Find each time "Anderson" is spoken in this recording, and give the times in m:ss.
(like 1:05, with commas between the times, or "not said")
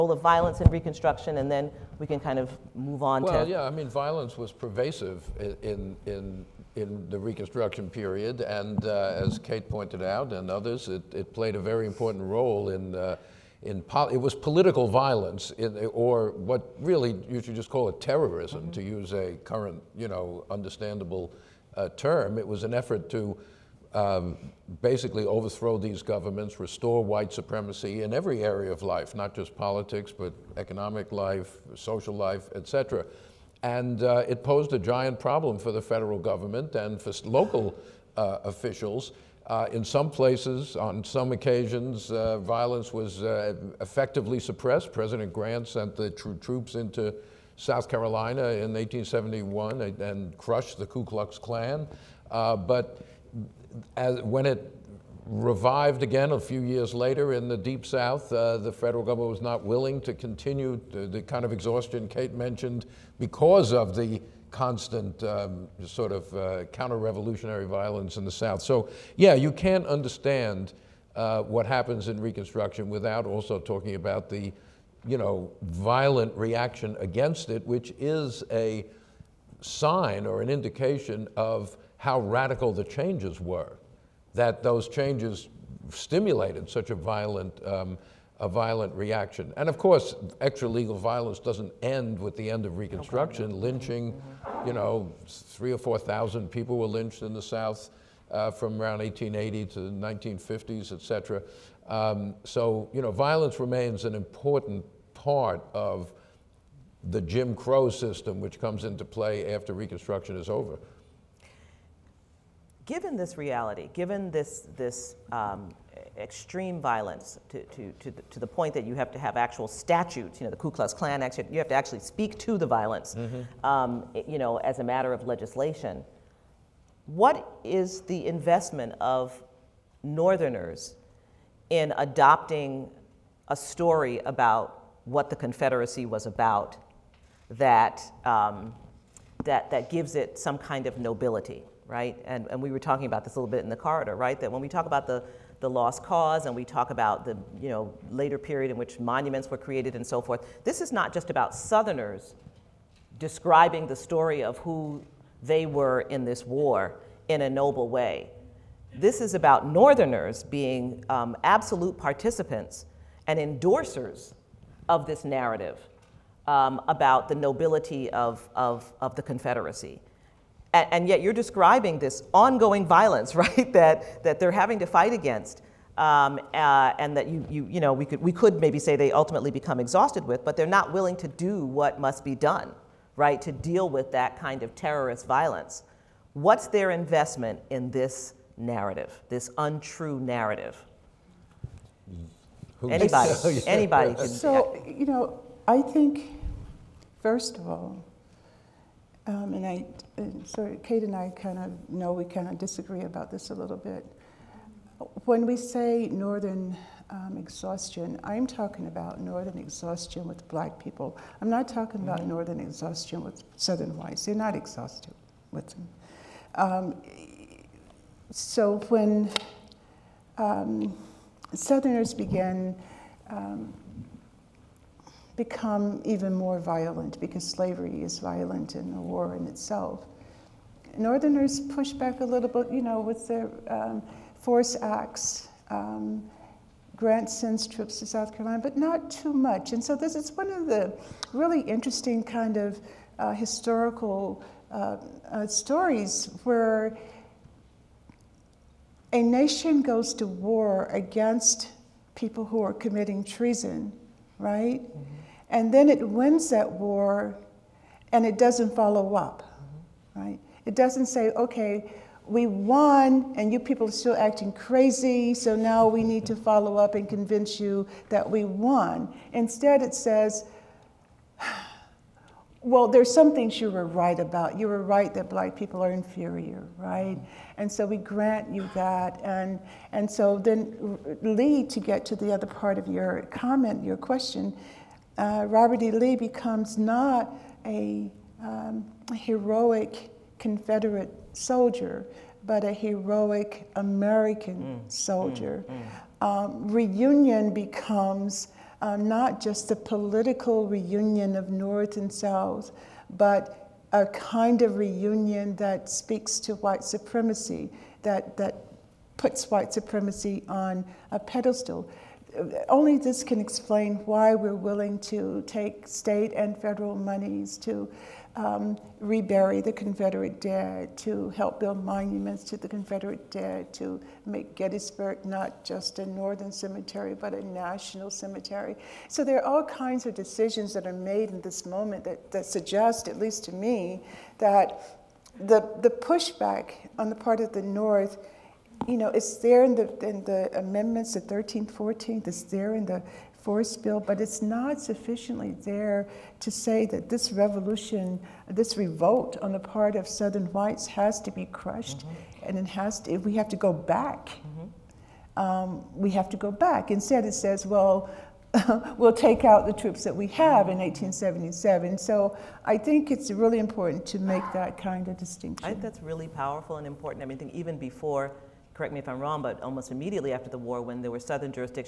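not said.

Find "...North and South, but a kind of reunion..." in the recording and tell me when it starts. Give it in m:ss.
5:01.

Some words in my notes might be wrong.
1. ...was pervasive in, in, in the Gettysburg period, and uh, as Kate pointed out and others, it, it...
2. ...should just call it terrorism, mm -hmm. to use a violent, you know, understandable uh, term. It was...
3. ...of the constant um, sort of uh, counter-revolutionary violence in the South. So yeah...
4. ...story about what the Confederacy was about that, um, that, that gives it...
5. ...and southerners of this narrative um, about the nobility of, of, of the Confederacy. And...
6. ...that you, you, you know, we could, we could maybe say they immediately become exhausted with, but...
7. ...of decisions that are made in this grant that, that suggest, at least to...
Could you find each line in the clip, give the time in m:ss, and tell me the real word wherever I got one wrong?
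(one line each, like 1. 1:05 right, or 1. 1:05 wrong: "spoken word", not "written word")
1. 0:04 wrong: "Reconstruction", not "Gettysburg"
2. 0:17 wrong: "current", not "violent"
3. 1:03 right
4. 2:13 right
5. 2:43 wrong: "endorsers", not "southerners"
6. 2:57 wrong: "ultimately", not "immediately"
7. 5:30 wrong: "moment", not "grant".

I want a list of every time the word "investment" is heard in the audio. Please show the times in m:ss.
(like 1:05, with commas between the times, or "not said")
2:08, 3:06.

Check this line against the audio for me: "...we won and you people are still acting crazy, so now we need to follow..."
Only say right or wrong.
right.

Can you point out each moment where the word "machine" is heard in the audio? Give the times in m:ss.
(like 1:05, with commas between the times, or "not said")
not said.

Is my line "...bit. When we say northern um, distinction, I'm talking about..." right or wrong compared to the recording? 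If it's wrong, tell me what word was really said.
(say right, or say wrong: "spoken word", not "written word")
wrong: "exhaustion", not "distinction".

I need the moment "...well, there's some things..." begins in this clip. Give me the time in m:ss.
4:32.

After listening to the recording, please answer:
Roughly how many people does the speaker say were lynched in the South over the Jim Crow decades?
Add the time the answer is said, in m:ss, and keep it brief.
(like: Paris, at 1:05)
3,000 to 4,000, at 1:35.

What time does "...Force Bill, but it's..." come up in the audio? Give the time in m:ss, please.
5:43.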